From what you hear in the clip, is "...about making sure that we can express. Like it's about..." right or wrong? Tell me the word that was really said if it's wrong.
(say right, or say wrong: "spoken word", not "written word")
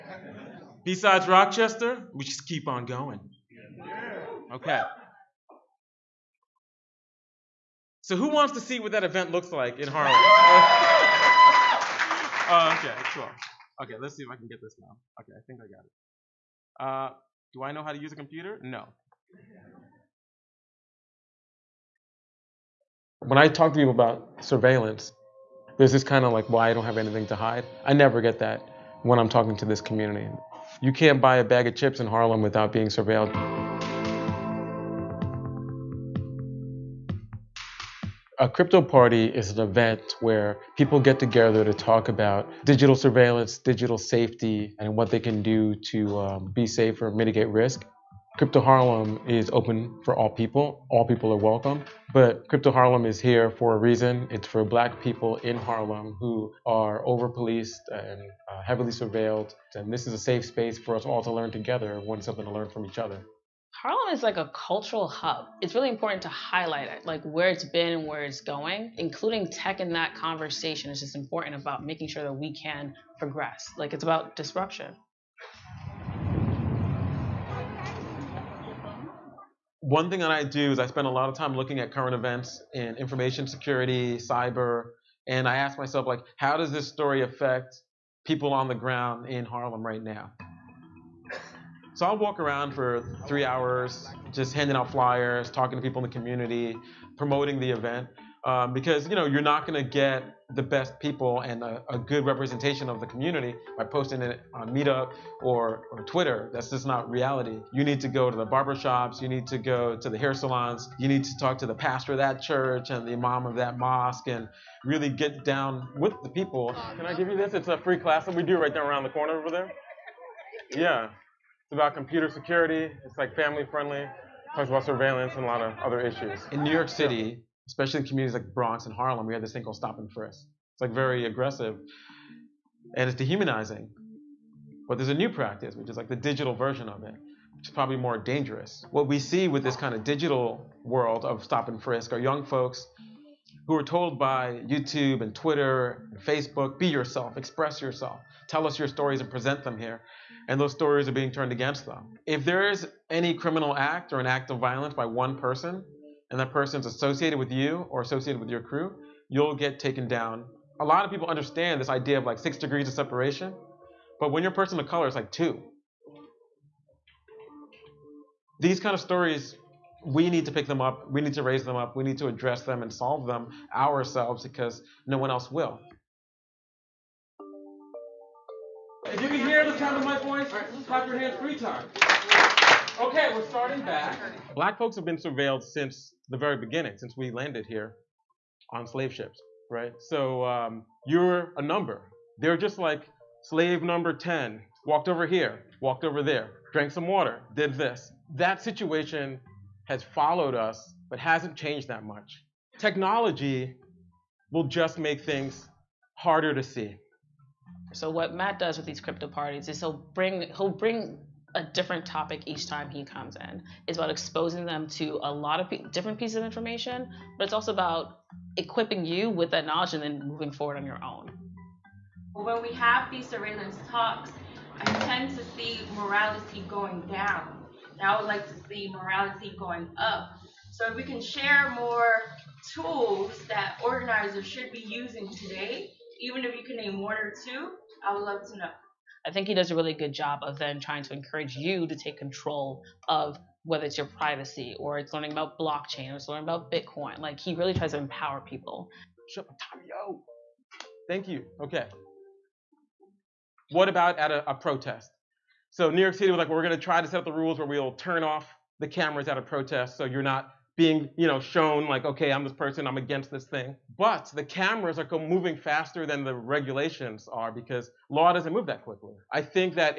wrong: "progress", not "express".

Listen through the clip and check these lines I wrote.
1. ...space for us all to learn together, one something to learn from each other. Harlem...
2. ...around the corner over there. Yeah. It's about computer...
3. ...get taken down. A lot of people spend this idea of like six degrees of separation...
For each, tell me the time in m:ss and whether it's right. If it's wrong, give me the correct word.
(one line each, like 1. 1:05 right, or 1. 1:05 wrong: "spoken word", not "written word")
1. 1:00 right
2. 1:58 right
3. 2:39 wrong: "understand", not "spend".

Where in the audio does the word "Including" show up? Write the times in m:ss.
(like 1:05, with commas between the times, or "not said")
1:08.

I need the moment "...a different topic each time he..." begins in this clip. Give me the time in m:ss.
3:31.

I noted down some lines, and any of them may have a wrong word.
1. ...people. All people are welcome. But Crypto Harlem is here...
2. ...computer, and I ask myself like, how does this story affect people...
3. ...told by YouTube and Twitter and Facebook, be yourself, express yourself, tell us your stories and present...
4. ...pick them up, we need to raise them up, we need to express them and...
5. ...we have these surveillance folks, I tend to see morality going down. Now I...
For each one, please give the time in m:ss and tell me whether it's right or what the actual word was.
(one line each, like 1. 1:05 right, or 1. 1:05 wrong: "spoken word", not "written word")
1. 0:50 right
2. 1:24 wrong: "cyber", not "computer"
3. 2:23 right
4. 2:50 wrong: "address", not "express"
5. 3:42 wrong: "talks", not "folks".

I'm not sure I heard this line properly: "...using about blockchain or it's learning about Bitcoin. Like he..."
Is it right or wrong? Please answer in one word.
wrong.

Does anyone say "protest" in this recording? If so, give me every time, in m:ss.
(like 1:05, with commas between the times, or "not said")
4:14, 4:19.